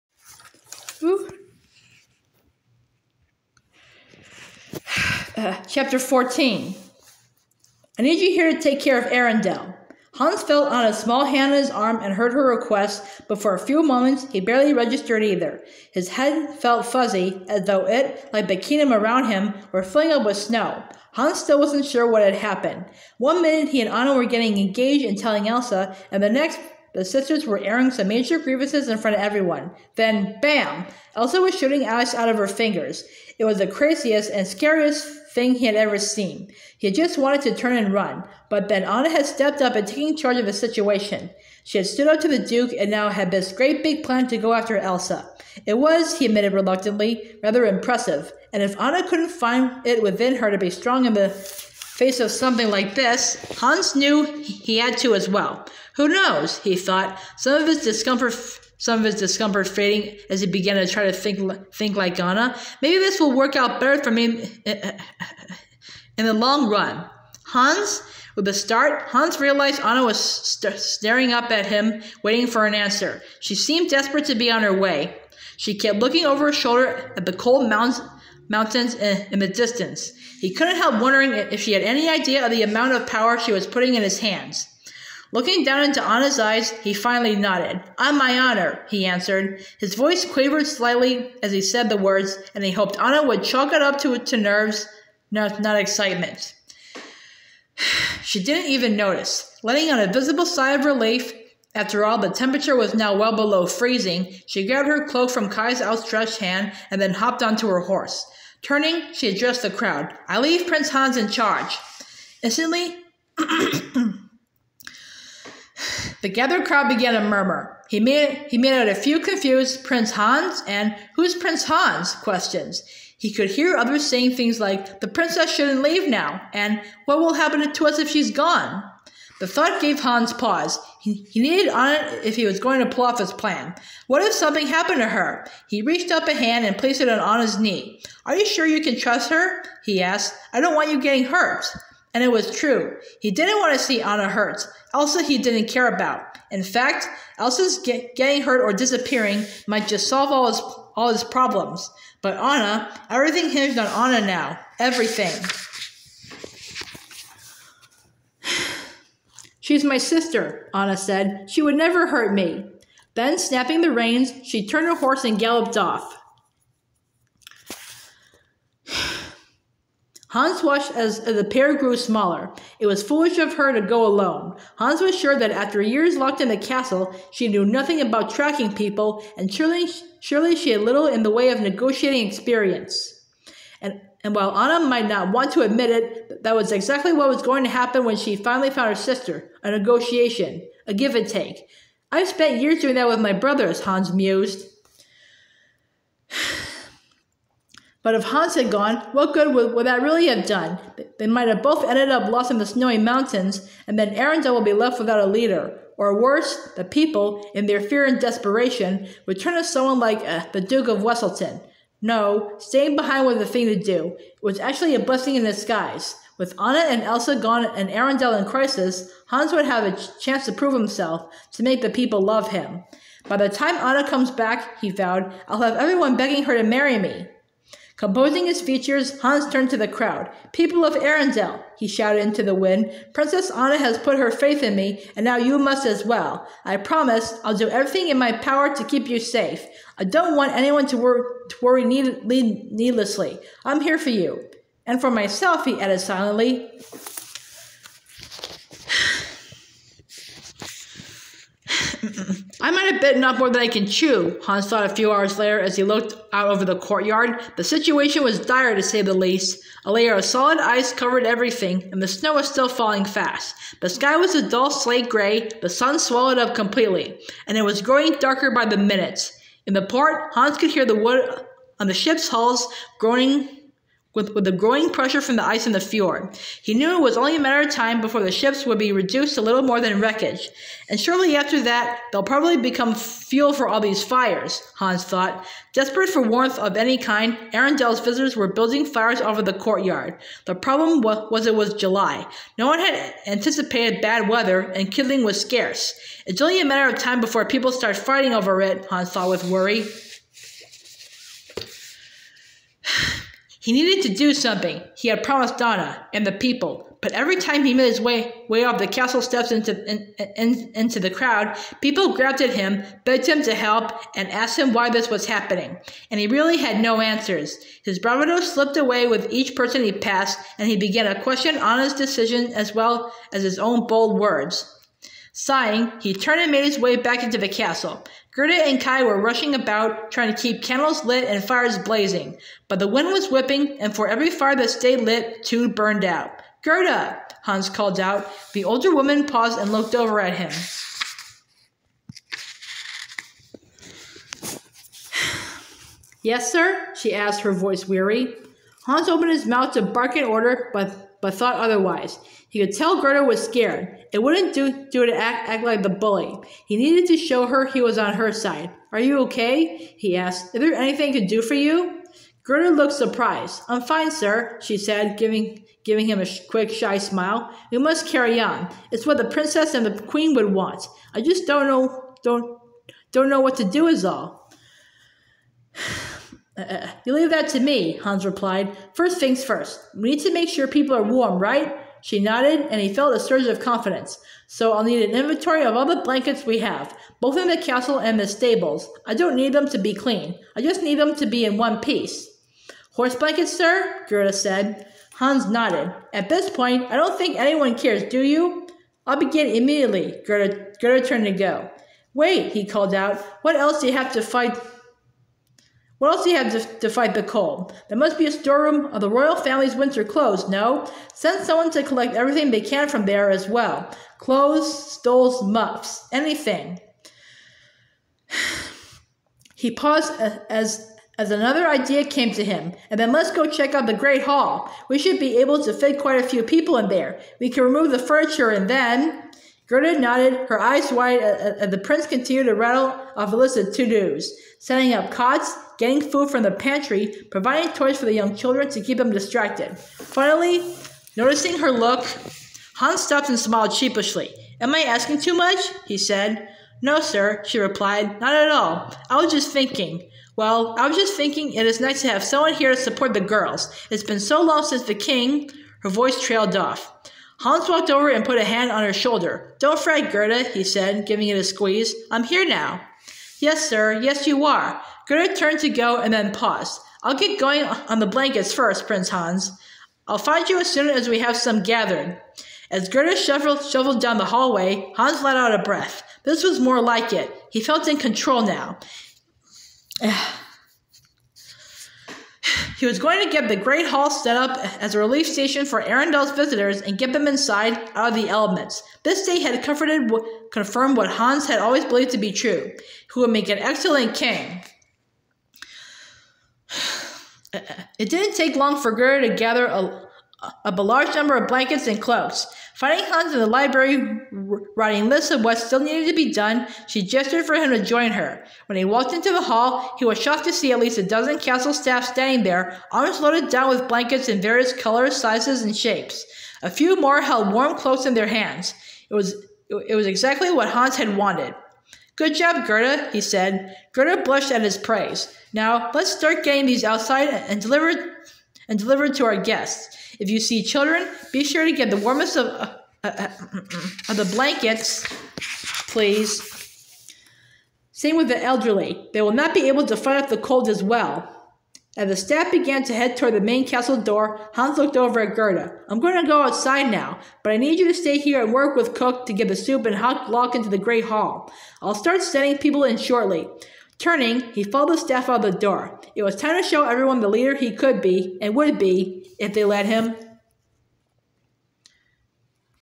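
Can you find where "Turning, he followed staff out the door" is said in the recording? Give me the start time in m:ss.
9:14.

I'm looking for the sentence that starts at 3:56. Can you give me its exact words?
I promise I'll do everything in my power to keep you safe.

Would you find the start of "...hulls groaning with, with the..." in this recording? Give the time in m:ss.
4:32.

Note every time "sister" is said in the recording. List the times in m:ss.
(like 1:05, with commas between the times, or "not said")
0:27, 2:39, 3:08.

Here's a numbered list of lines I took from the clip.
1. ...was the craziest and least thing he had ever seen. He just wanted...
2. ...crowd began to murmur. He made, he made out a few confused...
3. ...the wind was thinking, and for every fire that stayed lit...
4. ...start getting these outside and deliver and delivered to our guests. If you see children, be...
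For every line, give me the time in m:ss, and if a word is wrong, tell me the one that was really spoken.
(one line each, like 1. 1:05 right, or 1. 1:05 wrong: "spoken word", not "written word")
1. 0:33 wrong: "scariest", not "least"
2. 1:56 right
3. 5:32 wrong: "whipping", not "thinking"
4. 8:46 right.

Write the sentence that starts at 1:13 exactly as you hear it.
She seemed desperate to be on her way.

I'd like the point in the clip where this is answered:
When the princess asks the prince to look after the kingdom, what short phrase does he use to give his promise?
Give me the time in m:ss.
1:27.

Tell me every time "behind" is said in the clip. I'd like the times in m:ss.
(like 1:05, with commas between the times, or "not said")
3:32.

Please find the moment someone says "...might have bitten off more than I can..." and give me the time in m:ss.
4:12.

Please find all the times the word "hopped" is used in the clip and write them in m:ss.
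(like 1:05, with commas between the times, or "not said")
1:47.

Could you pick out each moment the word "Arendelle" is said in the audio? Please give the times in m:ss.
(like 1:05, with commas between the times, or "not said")
0:09, 3:24, 3:37, 3:50, 4:47, 8:05.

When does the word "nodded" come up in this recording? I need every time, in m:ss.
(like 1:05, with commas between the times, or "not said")
1:27, 6:22, 6:35, 7:09.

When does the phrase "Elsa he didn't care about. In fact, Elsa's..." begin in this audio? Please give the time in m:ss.
2:24.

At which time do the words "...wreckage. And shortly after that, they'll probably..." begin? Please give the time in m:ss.
4:40.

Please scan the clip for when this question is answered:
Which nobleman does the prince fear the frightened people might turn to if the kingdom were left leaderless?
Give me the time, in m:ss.
3:30.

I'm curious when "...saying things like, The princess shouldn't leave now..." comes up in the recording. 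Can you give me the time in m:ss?
2:04.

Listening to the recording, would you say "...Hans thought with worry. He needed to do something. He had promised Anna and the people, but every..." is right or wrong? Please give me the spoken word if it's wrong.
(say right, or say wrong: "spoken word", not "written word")
right.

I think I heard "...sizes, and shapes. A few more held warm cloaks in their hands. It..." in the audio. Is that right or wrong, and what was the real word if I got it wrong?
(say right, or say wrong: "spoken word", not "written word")
right.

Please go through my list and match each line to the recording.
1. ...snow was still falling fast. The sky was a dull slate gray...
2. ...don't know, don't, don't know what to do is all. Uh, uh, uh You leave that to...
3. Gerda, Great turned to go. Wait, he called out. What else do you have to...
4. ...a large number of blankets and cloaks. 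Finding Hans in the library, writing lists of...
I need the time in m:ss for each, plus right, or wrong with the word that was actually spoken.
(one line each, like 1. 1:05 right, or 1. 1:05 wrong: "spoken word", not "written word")
1. 4:22 right
2. 6:11 right
3. 6:40 wrong: "Gerda", not "Great"
4. 8:20 right.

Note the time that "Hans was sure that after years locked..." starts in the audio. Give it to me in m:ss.
2:54.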